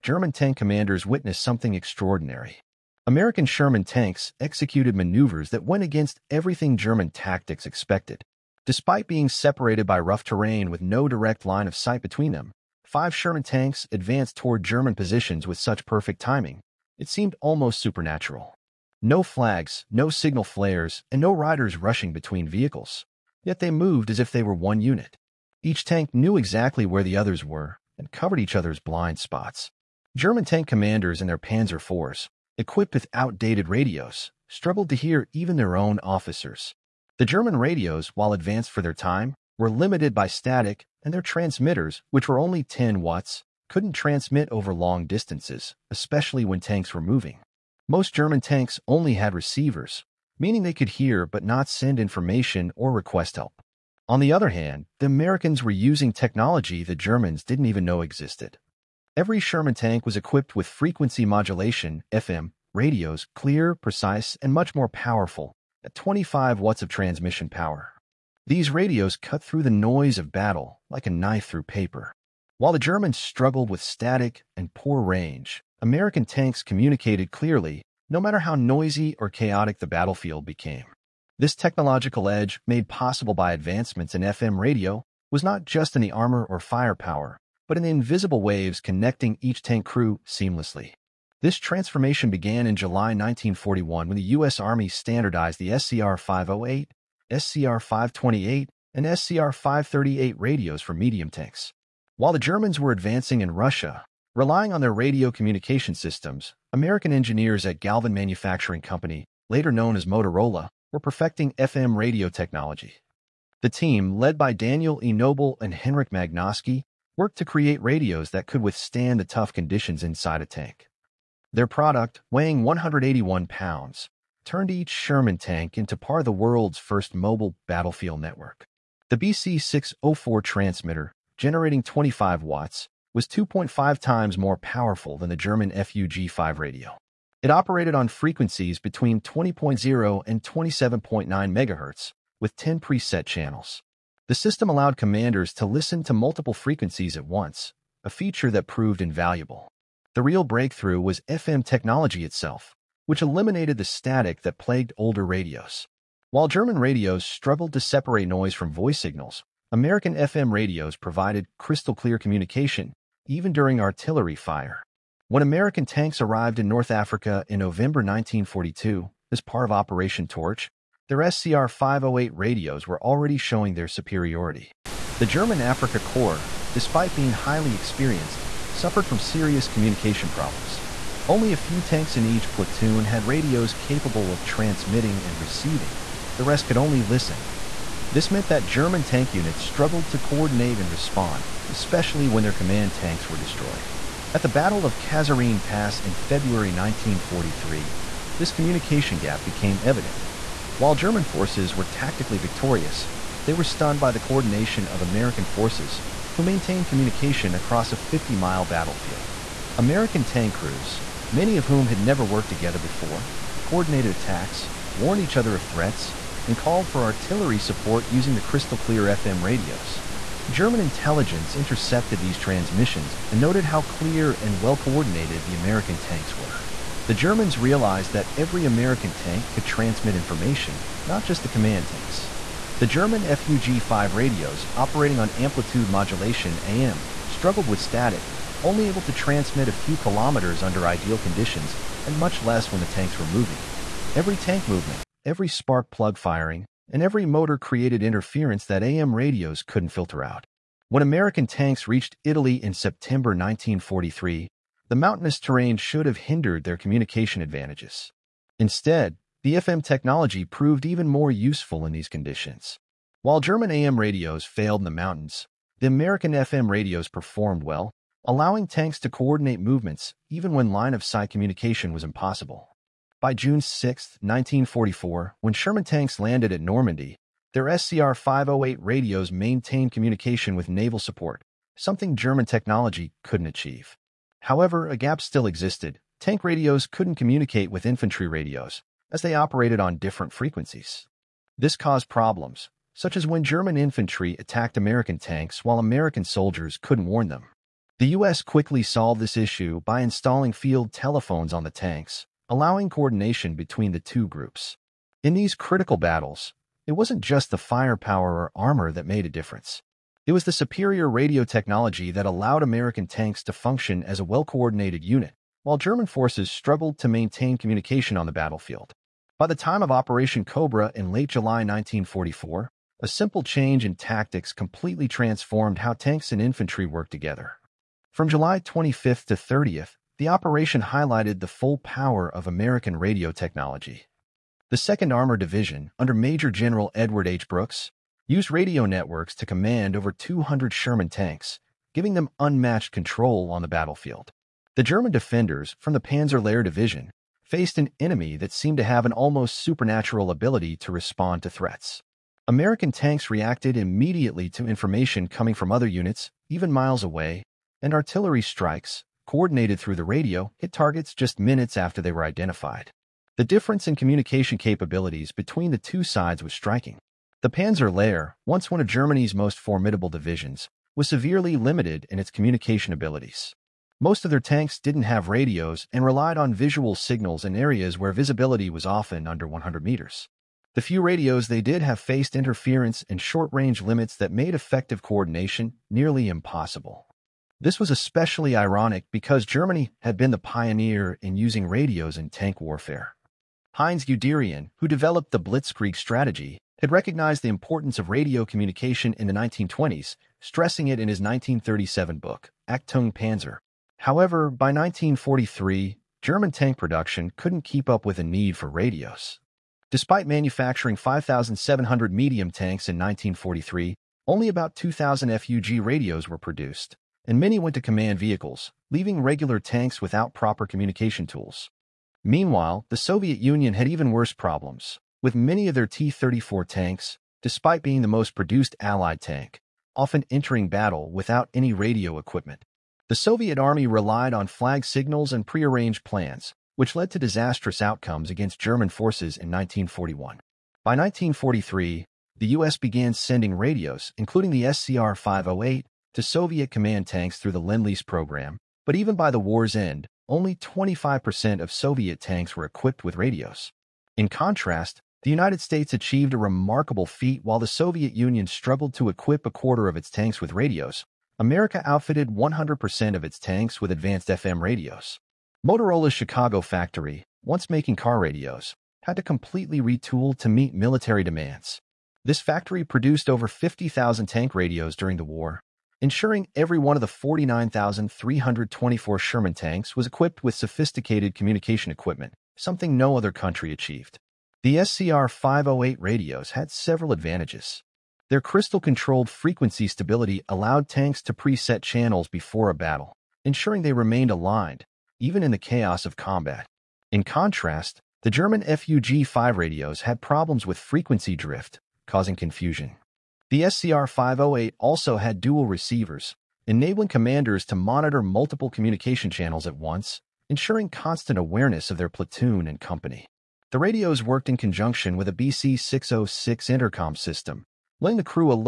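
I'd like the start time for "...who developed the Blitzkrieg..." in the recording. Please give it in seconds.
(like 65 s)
394 s.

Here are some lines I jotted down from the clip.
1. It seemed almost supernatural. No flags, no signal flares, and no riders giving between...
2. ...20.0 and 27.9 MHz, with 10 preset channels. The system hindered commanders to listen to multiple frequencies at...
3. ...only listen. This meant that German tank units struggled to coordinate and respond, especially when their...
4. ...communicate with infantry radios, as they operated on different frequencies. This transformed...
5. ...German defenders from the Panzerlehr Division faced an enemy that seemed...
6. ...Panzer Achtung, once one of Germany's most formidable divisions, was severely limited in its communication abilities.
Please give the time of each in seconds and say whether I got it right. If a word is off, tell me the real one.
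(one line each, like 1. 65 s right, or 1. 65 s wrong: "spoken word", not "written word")
1. 16 s wrong: "rushing", not "giving"
2. 139 s wrong: "allowed", not "hindered"
3. 186 s right
4. 287 s wrong: "caused", not "transformed"
5. 344 s right
6. 367 s wrong: "Lehr", not "Achtung".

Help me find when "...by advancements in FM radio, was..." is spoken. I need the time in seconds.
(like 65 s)
83 s.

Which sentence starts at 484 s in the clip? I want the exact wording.
The SCR-508 radios had several advantages.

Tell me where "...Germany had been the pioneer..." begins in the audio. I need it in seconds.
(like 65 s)
389 s.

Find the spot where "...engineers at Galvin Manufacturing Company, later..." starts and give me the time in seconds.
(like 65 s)
107 s.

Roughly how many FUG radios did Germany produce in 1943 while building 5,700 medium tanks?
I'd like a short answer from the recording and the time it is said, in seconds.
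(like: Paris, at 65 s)
2,000, at 414 s.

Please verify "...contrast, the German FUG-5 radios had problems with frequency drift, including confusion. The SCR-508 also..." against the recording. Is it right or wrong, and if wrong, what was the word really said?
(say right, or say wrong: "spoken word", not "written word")
wrong: "causing", not "including".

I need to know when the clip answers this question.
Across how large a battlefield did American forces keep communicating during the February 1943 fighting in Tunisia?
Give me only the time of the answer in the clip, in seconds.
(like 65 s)
207 s.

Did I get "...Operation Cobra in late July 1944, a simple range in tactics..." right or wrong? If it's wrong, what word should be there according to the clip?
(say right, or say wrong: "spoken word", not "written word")
wrong: "change", not "range".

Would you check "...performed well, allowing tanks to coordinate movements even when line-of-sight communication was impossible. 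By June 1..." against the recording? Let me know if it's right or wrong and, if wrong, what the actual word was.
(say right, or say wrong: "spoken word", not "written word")
wrong: "6", not "1".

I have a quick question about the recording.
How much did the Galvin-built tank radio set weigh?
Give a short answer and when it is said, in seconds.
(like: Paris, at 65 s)
181 pounds, at 122 s.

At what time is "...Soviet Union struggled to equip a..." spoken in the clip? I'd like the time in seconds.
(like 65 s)
457 s.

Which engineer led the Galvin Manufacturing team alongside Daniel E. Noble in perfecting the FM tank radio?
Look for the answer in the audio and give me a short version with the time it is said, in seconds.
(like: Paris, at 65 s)
Henryk Magnuski, at 115 s.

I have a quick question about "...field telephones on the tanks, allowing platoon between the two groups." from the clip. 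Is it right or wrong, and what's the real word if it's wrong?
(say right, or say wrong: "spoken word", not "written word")
wrong: "coordination", not "platoon".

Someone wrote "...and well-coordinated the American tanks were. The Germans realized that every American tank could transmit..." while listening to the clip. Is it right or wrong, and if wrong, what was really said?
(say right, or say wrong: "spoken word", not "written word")
right.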